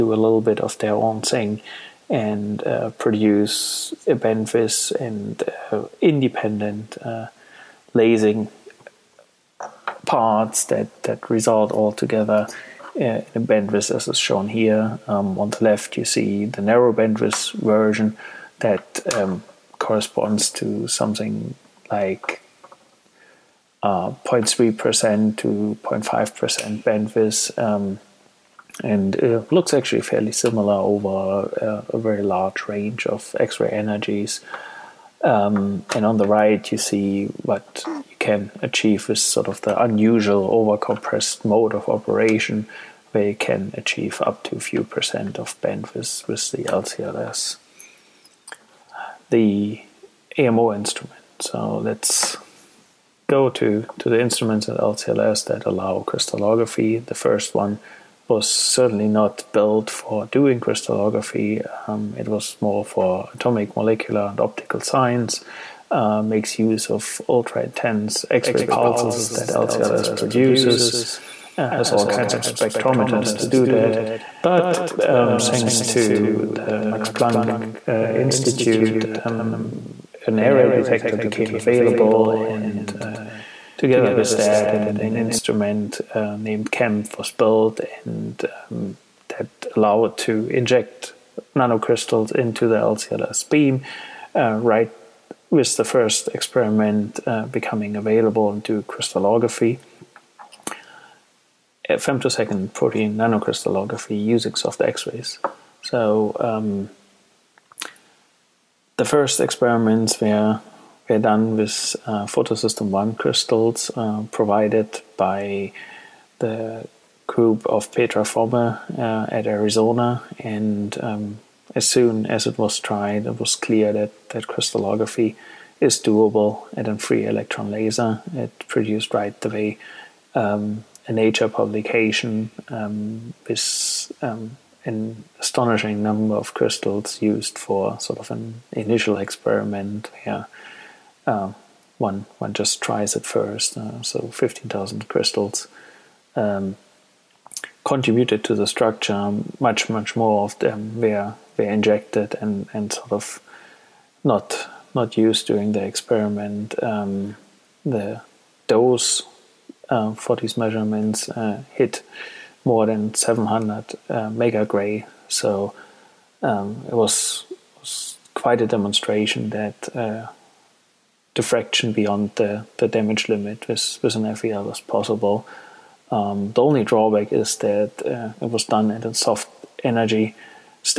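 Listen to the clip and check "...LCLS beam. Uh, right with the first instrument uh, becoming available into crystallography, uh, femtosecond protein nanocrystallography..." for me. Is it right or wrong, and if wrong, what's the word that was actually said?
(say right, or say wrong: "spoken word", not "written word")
wrong: "experiment", not "instrument".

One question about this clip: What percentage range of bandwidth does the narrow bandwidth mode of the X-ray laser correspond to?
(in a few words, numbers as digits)
0.3% to 0.5%.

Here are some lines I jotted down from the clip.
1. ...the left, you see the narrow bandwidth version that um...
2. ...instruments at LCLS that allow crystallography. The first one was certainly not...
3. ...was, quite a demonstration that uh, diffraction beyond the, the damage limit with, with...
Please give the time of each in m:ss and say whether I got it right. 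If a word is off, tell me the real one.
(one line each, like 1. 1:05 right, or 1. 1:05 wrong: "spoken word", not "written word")
1. 0:15 right
2. 0:54 right
3. 2:47 right.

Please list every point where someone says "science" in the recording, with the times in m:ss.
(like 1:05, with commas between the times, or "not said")
1:04.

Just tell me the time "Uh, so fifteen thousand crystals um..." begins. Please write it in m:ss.
2:23.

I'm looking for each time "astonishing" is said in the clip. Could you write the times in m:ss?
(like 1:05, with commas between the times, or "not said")
2:15.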